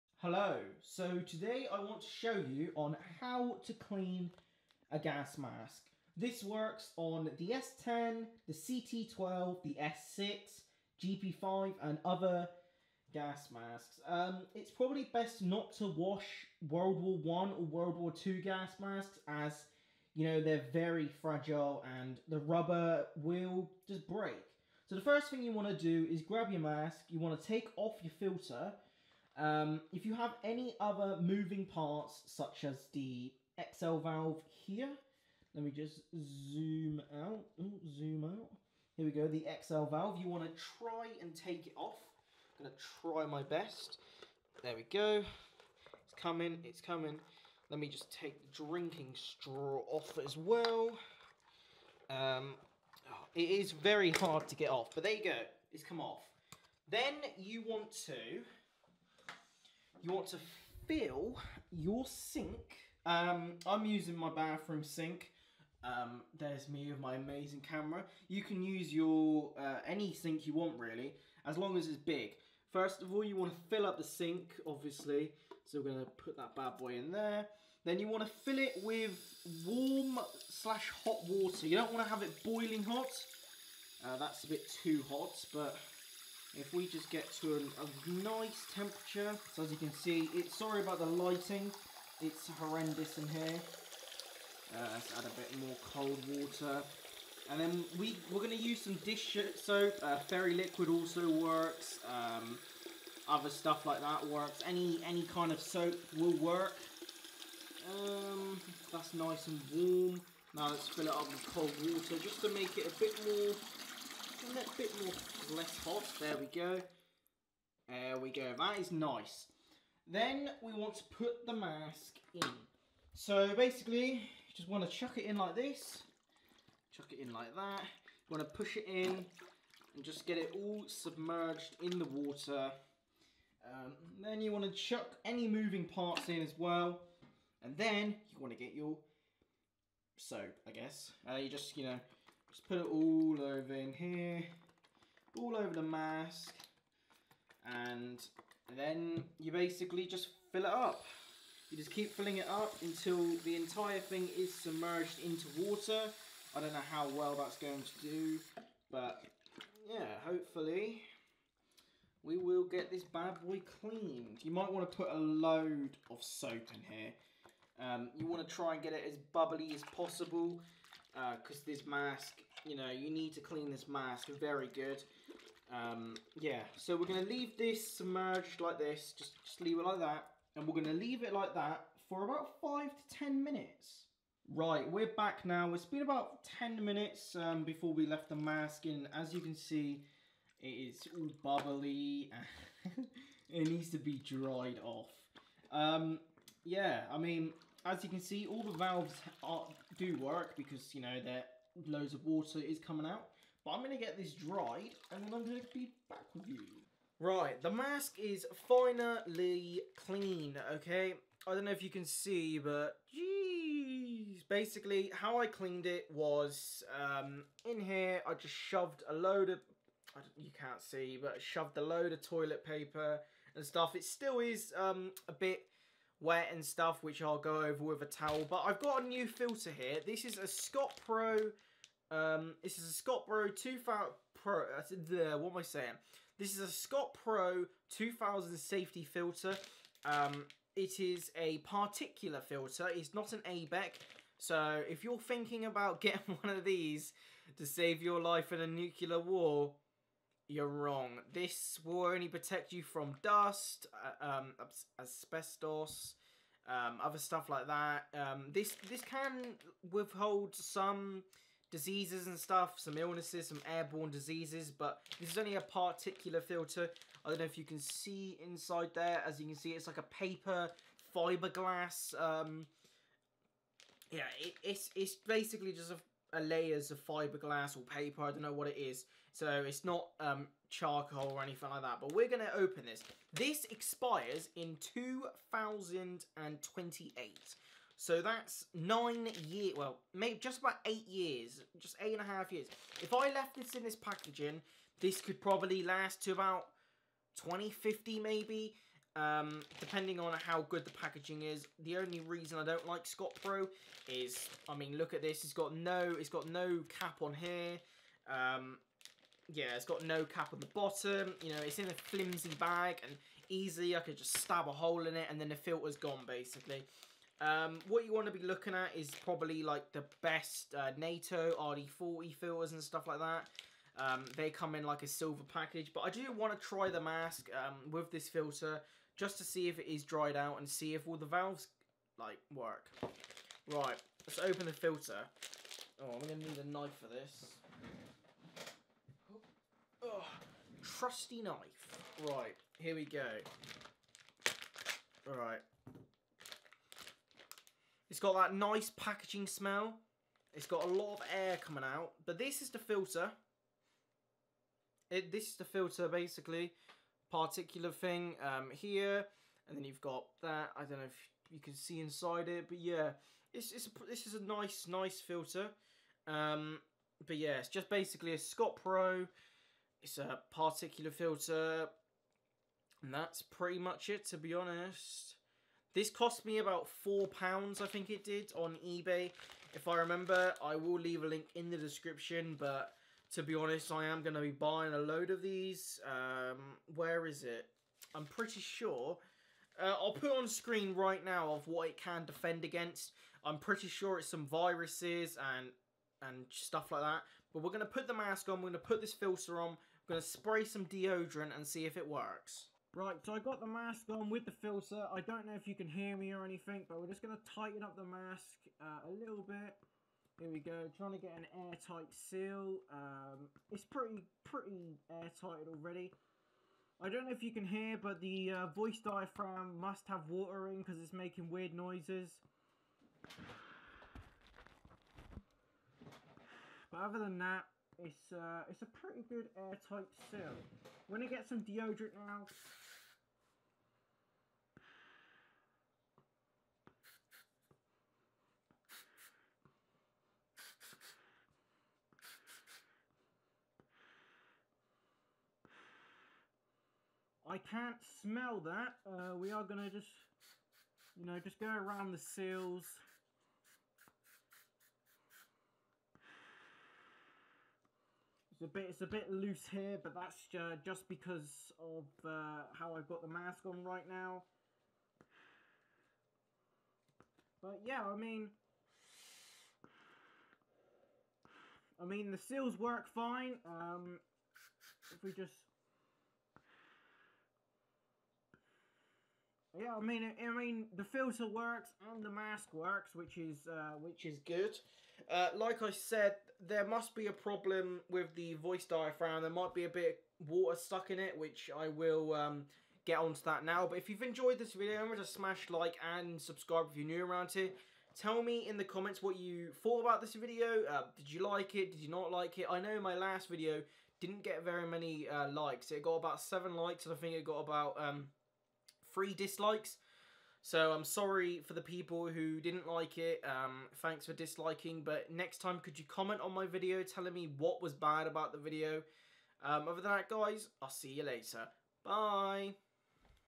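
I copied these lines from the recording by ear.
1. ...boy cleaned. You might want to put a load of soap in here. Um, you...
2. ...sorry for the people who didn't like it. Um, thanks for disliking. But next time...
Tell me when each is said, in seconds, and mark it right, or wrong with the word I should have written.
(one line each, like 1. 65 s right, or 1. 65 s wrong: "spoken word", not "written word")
1. 163 s right
2. 511 s right.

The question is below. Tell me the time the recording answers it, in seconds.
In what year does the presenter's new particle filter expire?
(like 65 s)
284 s.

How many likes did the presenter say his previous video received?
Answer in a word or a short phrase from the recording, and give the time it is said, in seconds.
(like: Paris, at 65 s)
7, at 506 s.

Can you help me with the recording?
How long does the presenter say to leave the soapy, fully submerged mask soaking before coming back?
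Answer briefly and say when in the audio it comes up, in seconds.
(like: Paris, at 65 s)
5 to 10 minutes, at 182 s.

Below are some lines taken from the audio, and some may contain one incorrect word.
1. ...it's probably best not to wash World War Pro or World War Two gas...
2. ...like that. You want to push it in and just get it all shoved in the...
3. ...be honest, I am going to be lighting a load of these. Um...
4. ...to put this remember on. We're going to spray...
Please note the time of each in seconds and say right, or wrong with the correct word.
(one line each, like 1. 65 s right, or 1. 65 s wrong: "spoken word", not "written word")
1. 14 s wrong: "One", not "Pro"
2. 127 s wrong: "submerged", not "shoved"
3. 383 s wrong: "buying", not "lighting"
4. 398 s wrong: "filter", not "remember".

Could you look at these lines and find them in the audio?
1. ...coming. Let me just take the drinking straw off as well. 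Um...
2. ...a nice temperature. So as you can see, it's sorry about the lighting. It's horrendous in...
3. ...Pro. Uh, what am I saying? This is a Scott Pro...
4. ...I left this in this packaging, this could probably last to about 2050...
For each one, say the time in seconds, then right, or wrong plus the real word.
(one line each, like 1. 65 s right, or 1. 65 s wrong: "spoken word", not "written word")
1. 46 s right
2. 87 s right
3. 234 s right
4. 293 s right.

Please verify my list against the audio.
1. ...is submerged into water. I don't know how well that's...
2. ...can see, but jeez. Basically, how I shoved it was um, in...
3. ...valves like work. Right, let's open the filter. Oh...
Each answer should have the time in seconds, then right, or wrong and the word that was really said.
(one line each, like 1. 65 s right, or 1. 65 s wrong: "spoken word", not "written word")
1. 154 s right
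2. 211 s wrong: "cleaned", not "shoved"
3. 331 s right.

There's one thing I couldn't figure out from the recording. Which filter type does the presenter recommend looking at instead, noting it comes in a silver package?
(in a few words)
NATO RD40.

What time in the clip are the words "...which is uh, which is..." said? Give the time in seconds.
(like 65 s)
483 s.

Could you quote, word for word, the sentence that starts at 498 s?
Tell me in the comments what you thought about this video.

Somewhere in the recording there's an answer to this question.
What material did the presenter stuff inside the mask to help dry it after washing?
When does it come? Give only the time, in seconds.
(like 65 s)
222 s.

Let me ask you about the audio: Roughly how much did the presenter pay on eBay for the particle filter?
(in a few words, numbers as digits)
£4.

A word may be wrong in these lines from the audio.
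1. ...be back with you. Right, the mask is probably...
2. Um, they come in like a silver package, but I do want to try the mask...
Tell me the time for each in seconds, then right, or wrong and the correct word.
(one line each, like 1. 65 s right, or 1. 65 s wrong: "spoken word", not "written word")
1. 205 s wrong: "finally", not "probably"
2. 323 s right.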